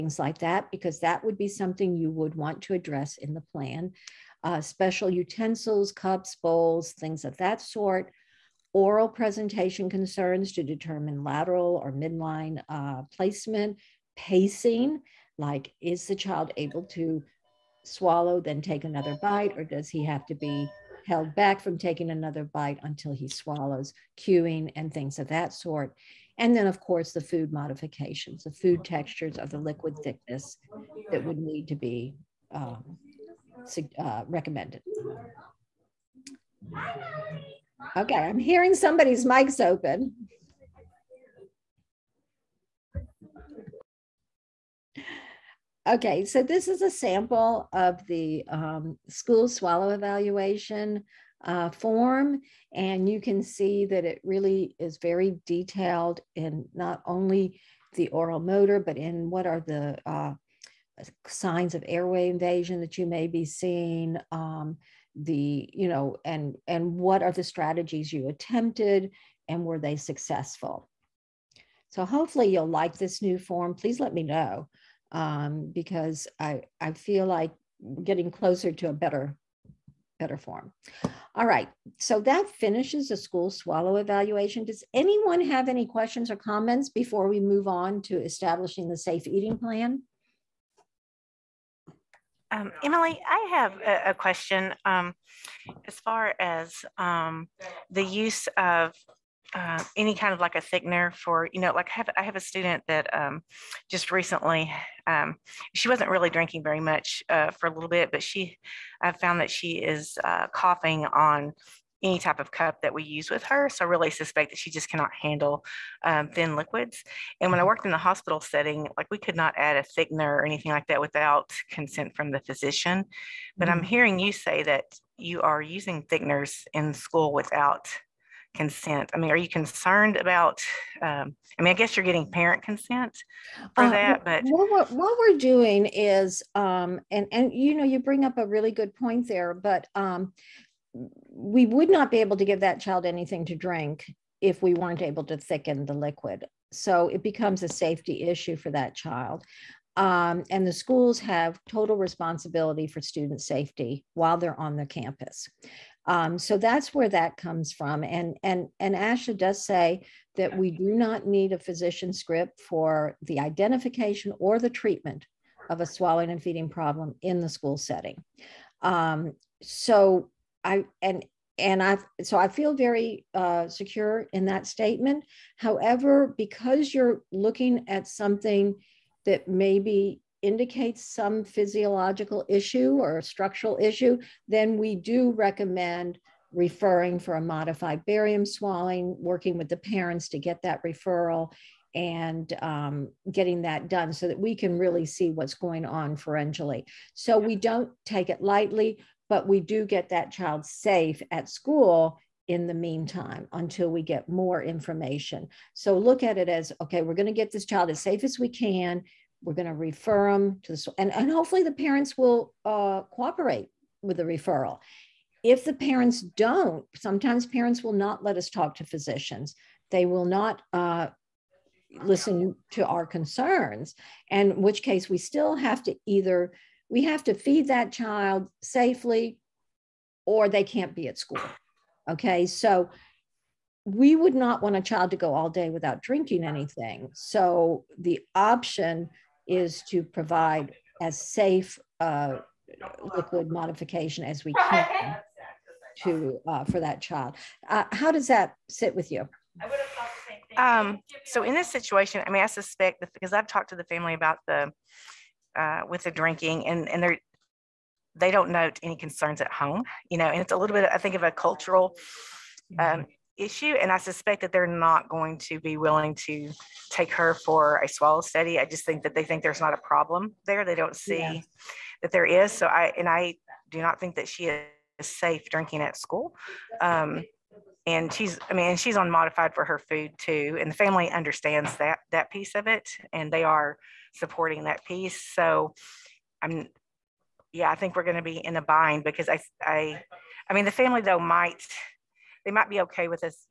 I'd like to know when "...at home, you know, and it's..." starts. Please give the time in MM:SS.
04:19.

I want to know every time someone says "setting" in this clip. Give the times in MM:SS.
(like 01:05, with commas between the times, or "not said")
01:58, 02:47.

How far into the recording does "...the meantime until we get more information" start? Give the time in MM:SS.
03:22.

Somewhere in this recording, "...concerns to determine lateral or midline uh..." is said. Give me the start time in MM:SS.
00:09.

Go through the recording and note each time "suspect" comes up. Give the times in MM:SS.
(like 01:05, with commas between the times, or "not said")
01:54, 04:12, 04:23.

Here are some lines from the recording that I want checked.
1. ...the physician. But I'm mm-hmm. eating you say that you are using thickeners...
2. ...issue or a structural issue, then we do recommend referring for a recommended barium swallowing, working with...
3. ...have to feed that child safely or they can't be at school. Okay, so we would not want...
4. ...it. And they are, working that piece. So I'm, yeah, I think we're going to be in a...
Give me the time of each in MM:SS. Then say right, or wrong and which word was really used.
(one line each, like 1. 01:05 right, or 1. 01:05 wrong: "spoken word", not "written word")
1. 02:02 wrong: "hearing", not "eating"
2. 03:02 wrong: "modified", not "recommended"
3. 03:47 right
4. 04:42 wrong: "supporting", not "working".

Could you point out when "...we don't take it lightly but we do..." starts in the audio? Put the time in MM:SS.
03:17.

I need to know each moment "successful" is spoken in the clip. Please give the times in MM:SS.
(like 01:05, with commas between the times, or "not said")
01:09.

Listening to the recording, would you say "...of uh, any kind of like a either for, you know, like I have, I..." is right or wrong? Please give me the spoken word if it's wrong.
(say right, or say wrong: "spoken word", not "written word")
wrong: "thickener", not "either".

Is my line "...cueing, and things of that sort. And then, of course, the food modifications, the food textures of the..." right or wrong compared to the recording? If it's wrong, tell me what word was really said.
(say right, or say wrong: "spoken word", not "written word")
right.